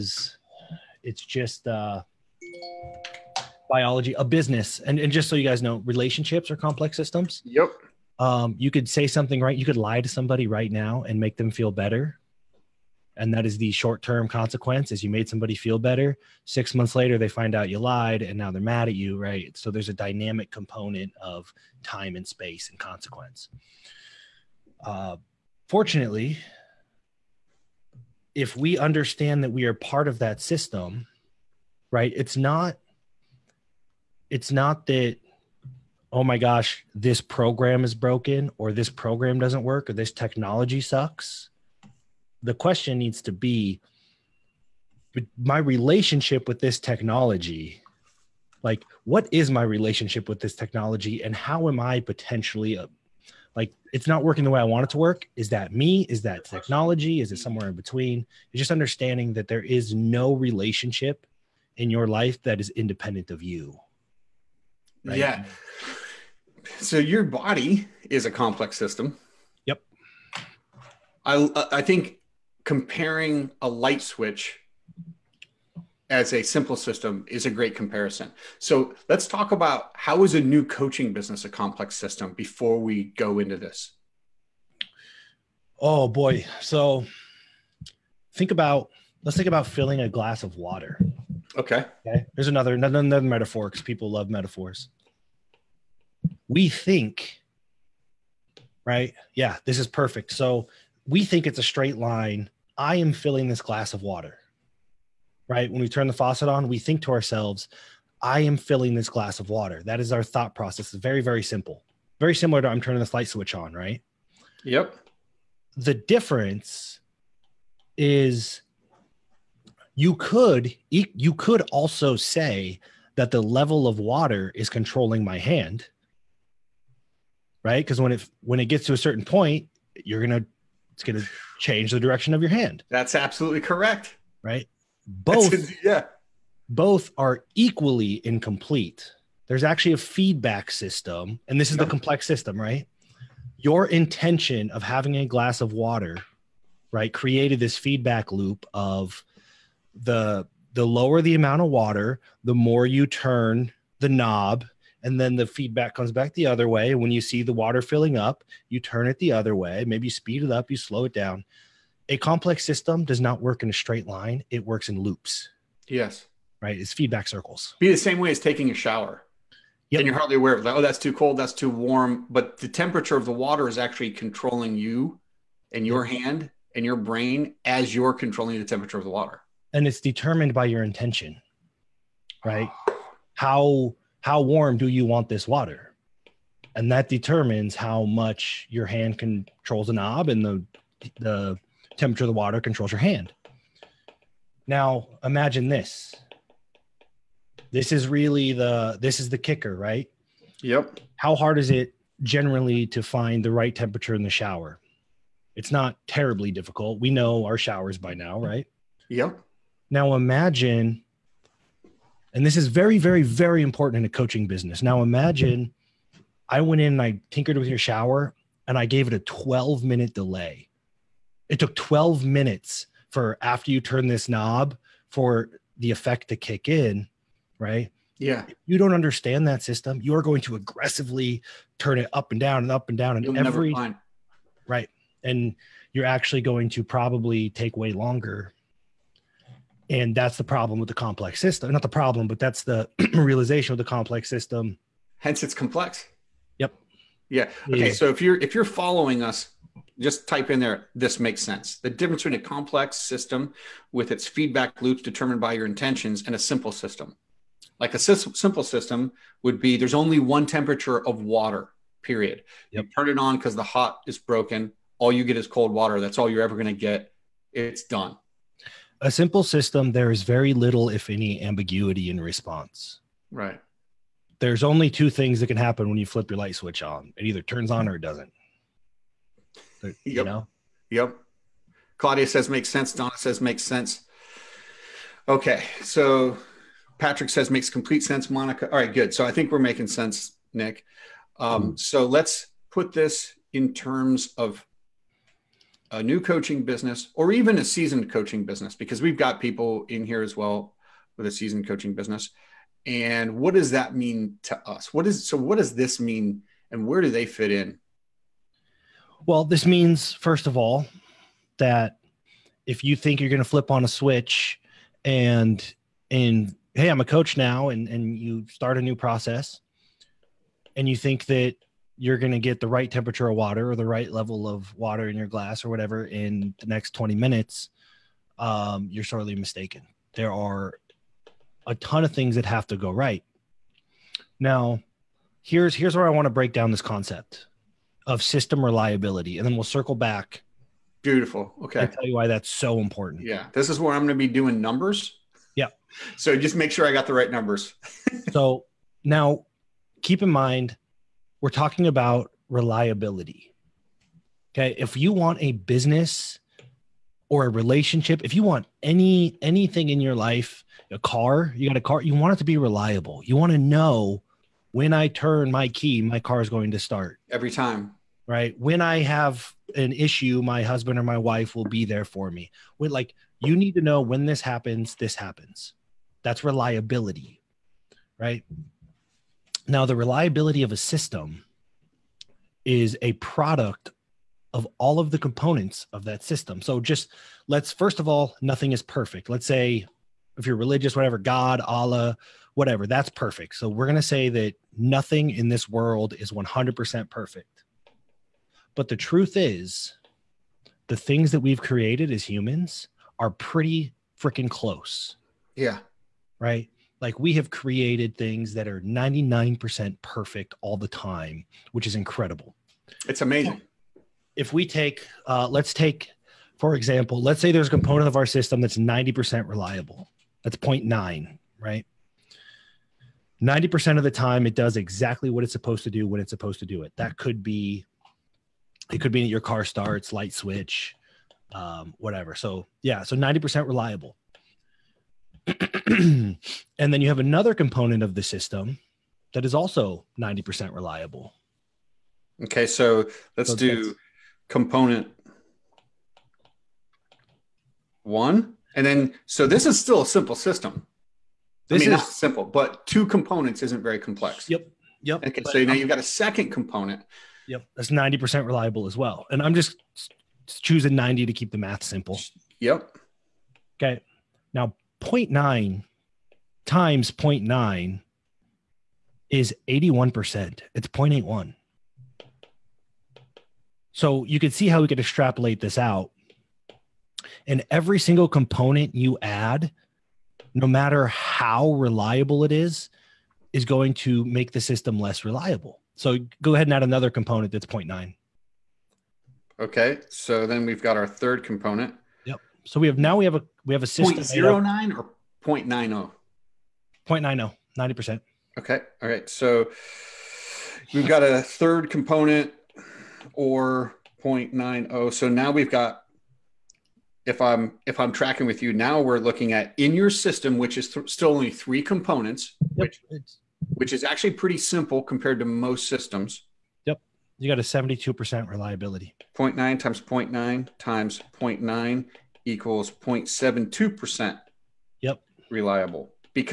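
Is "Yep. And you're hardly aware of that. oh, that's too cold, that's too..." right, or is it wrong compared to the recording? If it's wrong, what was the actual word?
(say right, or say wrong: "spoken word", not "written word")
right.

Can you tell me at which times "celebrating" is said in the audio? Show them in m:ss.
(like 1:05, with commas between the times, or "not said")
not said.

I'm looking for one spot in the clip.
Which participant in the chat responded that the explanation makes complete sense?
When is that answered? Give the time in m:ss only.
4:46.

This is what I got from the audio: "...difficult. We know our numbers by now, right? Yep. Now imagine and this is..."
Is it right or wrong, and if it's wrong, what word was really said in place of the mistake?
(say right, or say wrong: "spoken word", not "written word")
wrong: "showers", not "numbers".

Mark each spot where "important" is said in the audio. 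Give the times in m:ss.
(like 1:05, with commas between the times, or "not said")
3:33, 5:42.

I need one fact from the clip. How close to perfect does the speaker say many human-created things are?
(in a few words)
99%.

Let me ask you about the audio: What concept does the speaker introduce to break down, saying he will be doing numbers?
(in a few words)
System reliability.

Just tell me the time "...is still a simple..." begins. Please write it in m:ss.
7:29.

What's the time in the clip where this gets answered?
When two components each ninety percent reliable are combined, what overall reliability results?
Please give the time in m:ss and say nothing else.
7:49.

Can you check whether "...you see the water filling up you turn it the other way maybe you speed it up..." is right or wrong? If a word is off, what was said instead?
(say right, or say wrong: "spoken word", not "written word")
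right.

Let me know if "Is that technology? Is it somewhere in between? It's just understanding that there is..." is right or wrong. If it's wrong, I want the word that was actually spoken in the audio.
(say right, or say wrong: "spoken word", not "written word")
right.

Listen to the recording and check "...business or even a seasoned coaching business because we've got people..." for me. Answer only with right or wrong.
right.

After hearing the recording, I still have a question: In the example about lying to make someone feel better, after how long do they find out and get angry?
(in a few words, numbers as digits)
6 months.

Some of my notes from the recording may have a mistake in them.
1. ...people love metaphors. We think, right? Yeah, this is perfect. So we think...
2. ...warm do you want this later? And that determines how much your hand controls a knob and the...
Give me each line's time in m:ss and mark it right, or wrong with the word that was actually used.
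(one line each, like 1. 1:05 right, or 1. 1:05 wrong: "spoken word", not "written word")
1. 1:33 right
2. 3:04 wrong: "water", not "later".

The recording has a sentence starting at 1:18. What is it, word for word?
So let's talk about how is a new coaching business a complex system before we go into this.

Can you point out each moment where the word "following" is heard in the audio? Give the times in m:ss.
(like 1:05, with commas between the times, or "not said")
4:08.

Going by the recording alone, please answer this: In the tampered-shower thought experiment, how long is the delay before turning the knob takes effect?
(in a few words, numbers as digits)
12 minutes.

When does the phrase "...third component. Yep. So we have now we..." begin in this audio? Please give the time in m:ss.
8:11.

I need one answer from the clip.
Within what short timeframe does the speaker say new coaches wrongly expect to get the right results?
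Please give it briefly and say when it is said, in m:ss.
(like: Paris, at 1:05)
20 minutes, at 5:26.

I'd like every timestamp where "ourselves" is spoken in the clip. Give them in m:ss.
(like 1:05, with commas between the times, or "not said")
1:47.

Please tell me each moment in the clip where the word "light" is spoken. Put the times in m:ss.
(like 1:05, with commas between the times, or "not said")
1:13, 1:53, 4:36, 7:10.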